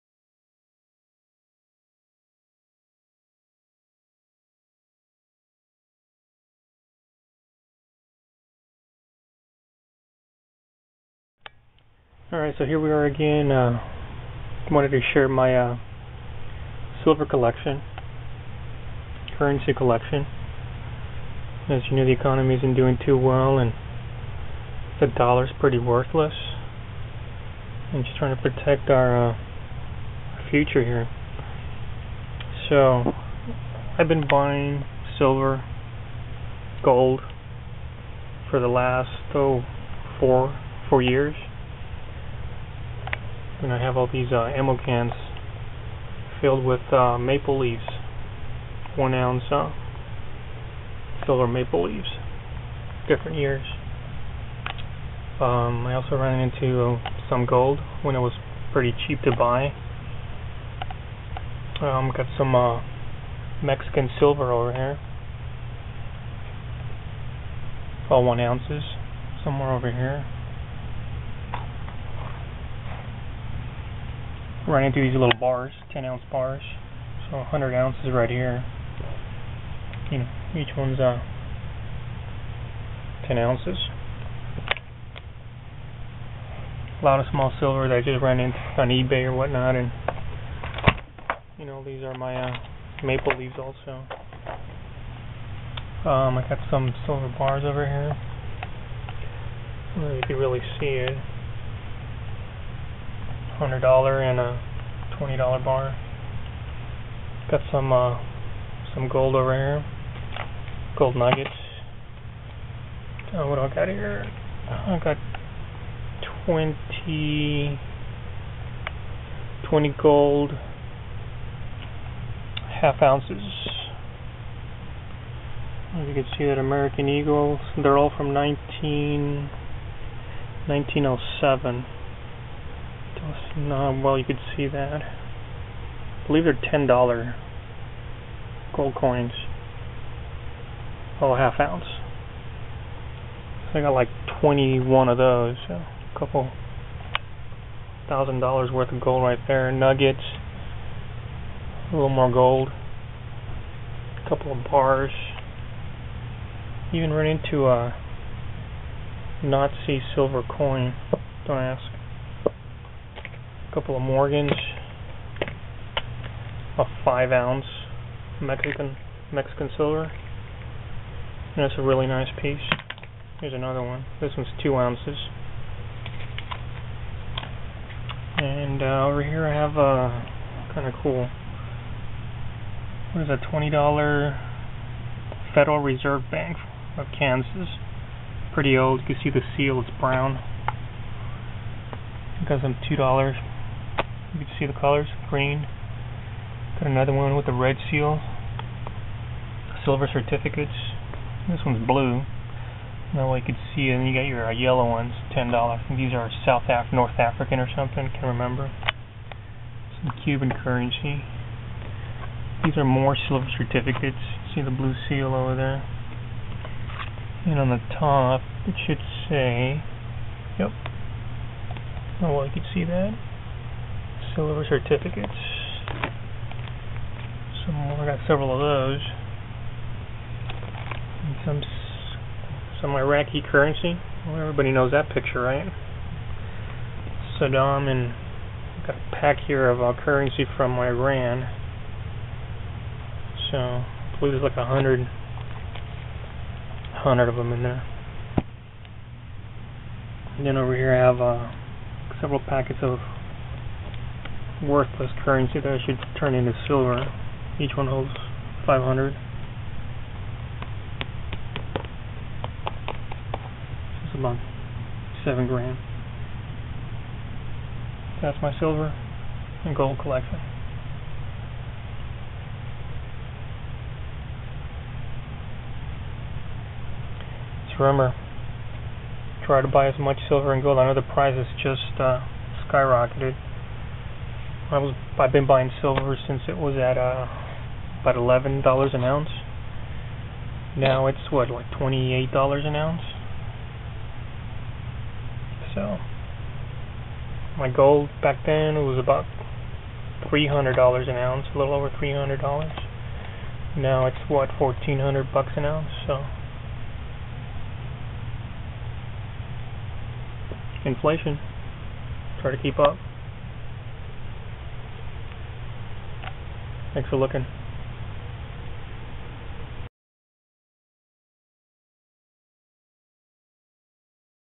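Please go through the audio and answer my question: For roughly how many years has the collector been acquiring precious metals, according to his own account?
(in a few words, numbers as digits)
4 years.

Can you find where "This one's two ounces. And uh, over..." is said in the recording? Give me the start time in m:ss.
2:54.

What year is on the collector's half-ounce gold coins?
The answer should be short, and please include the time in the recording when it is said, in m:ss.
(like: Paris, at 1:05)
1907, at 2:11.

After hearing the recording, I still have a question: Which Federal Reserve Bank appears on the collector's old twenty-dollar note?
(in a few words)
Kansas.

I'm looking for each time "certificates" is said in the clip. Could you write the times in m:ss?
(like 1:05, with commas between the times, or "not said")
3:20, 3:33, 3:44.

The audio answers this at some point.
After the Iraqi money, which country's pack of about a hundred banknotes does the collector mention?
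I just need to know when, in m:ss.
4:00.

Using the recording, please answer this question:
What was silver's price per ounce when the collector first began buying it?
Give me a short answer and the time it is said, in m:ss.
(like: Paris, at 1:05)
$11, at 4:48.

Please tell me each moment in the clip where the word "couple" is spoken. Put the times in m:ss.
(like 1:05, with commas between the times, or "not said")
2:26, 2:34, 2:43.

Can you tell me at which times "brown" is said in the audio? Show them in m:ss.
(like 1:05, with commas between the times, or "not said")
3:10.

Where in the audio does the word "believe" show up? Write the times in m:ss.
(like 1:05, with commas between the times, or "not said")
2:16, 4:04.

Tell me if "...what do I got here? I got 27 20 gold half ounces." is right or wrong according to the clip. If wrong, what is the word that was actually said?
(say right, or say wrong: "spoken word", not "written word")
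wrong: "20", not "27".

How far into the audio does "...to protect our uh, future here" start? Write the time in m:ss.
0:28.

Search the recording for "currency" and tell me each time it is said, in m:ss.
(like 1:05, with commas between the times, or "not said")
0:19, 3:30, 3:53, 4:00, 4:15.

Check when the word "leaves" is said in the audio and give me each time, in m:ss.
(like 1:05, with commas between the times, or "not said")
0:47, 0:51, 1:33.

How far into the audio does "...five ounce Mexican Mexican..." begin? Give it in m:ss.
2:47.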